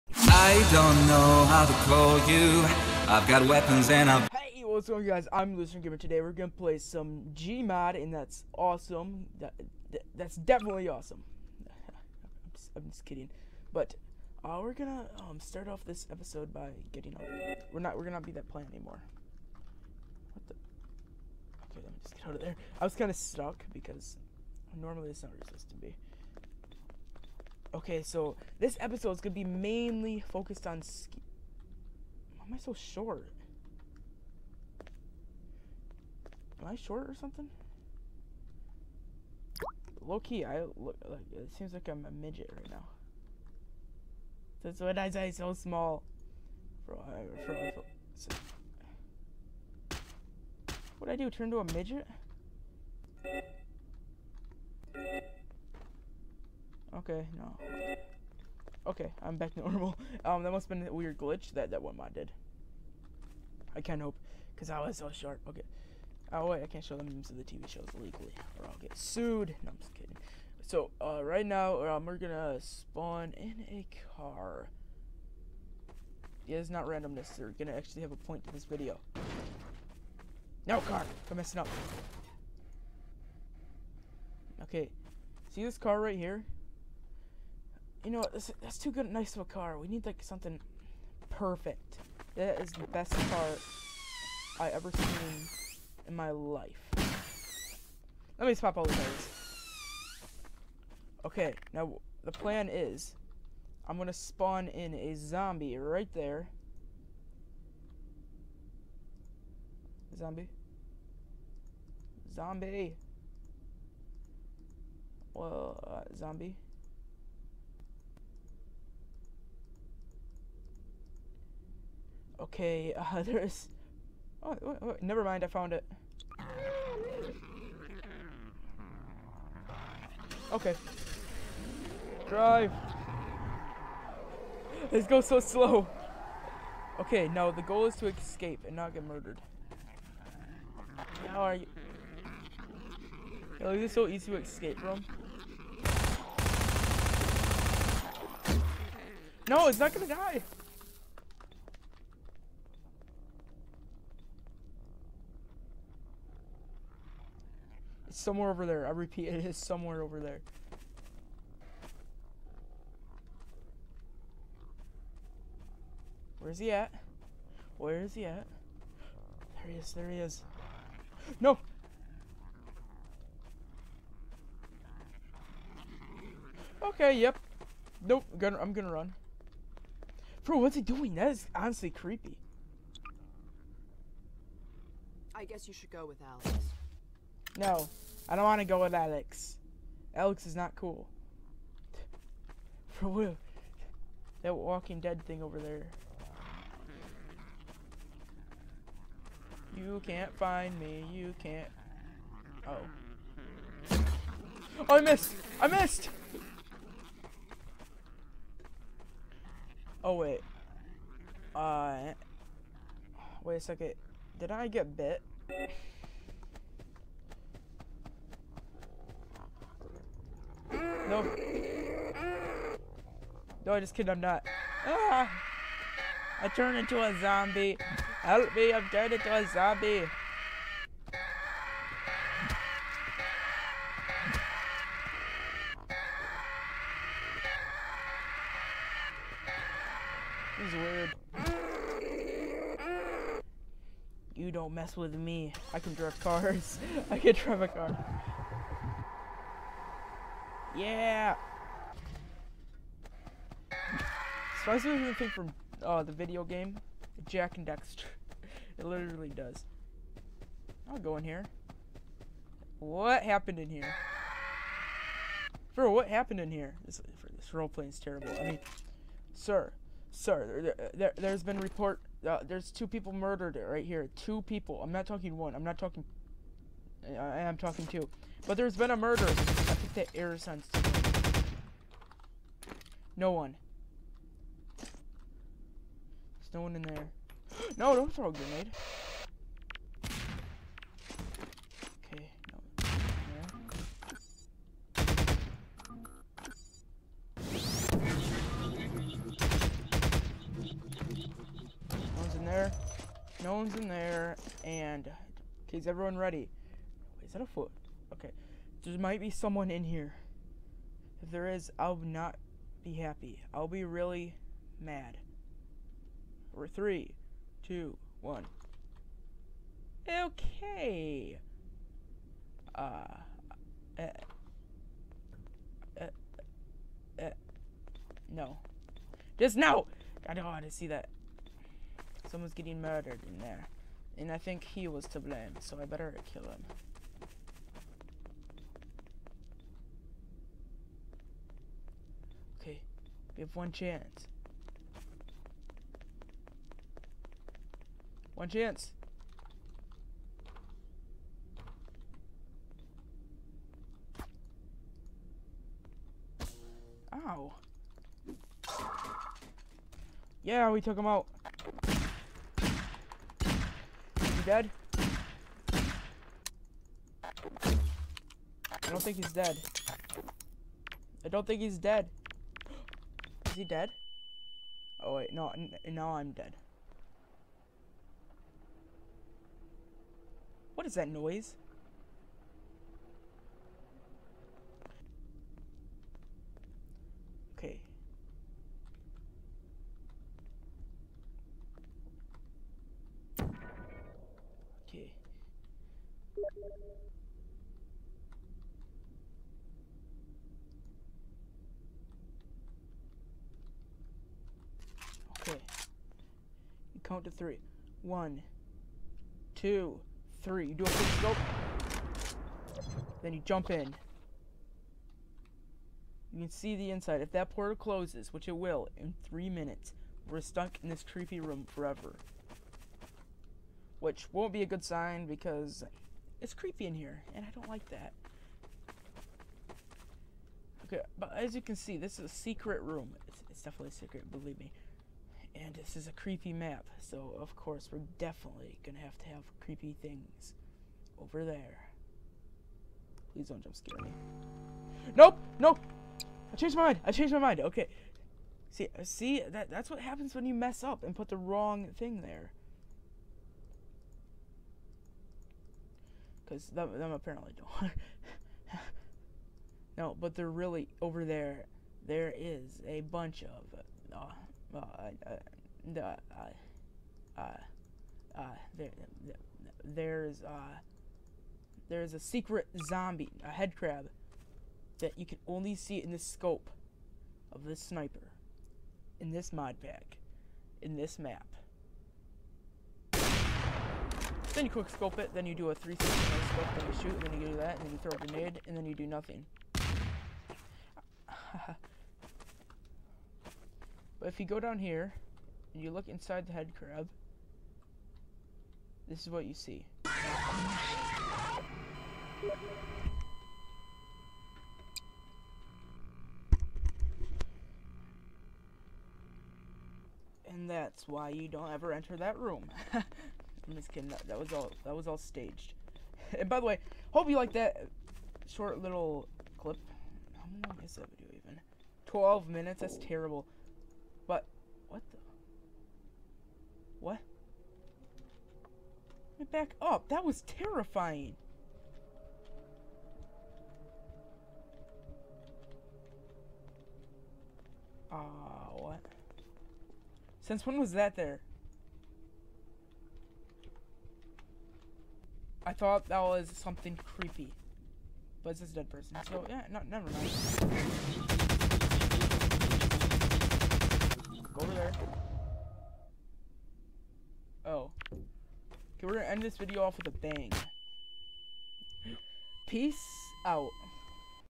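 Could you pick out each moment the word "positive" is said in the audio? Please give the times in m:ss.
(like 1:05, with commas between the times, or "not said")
not said.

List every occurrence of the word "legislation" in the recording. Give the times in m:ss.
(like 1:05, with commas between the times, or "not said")
not said.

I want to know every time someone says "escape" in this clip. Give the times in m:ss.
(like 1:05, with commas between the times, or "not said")
2:18, 2:24.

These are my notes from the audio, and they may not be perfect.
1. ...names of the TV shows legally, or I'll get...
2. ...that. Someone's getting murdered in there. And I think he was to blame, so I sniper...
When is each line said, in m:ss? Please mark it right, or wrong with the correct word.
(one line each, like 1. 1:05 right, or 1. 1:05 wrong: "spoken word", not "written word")
1. 1:07 right
2. 5:30 wrong: "better", not "sniper".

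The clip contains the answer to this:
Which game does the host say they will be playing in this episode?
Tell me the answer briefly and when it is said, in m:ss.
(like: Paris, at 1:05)
Gmod, at 0:07.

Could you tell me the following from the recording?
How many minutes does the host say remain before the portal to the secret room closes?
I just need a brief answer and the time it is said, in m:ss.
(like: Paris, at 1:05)
3, at 6:59.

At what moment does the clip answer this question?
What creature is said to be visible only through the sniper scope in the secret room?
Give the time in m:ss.
7:53.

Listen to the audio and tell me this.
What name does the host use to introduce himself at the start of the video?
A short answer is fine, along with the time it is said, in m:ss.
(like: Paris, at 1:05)
Lucian Gamer, at 0:05.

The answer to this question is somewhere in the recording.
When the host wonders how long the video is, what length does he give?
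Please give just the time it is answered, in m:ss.
8:42.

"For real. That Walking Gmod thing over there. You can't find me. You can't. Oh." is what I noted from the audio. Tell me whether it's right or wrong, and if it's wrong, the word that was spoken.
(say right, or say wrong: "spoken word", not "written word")
wrong: "Dead", not "Gmod".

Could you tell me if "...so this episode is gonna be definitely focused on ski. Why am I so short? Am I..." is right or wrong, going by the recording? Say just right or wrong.
wrong.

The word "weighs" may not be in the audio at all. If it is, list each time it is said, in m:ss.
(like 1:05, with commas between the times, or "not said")
not said.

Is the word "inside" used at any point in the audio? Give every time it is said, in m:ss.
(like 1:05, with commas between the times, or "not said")
6:56, 8:16.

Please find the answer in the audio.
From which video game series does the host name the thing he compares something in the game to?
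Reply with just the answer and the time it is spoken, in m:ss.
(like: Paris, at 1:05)
Jak and Daxter, at 4:17.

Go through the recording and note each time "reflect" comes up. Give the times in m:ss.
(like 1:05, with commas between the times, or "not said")
not said.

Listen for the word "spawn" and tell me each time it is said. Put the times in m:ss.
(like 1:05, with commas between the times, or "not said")
1:12, 1:44.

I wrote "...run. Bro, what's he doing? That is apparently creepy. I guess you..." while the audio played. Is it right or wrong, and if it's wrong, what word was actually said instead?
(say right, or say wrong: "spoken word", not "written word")
wrong: "honestly", not "apparently".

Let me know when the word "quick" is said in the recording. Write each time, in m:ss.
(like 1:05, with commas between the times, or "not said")
6:50, 8:04.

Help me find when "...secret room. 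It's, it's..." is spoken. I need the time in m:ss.
7:12.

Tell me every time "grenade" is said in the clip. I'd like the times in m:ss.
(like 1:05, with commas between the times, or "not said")
4:48, 8:08.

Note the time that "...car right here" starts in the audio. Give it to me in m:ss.
1:25.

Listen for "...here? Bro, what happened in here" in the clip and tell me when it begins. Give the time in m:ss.
4:23.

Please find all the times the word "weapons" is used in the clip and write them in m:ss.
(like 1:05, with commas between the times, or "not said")
0:03.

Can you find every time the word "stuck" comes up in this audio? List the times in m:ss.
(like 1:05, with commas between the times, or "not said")
0:23, 7:00.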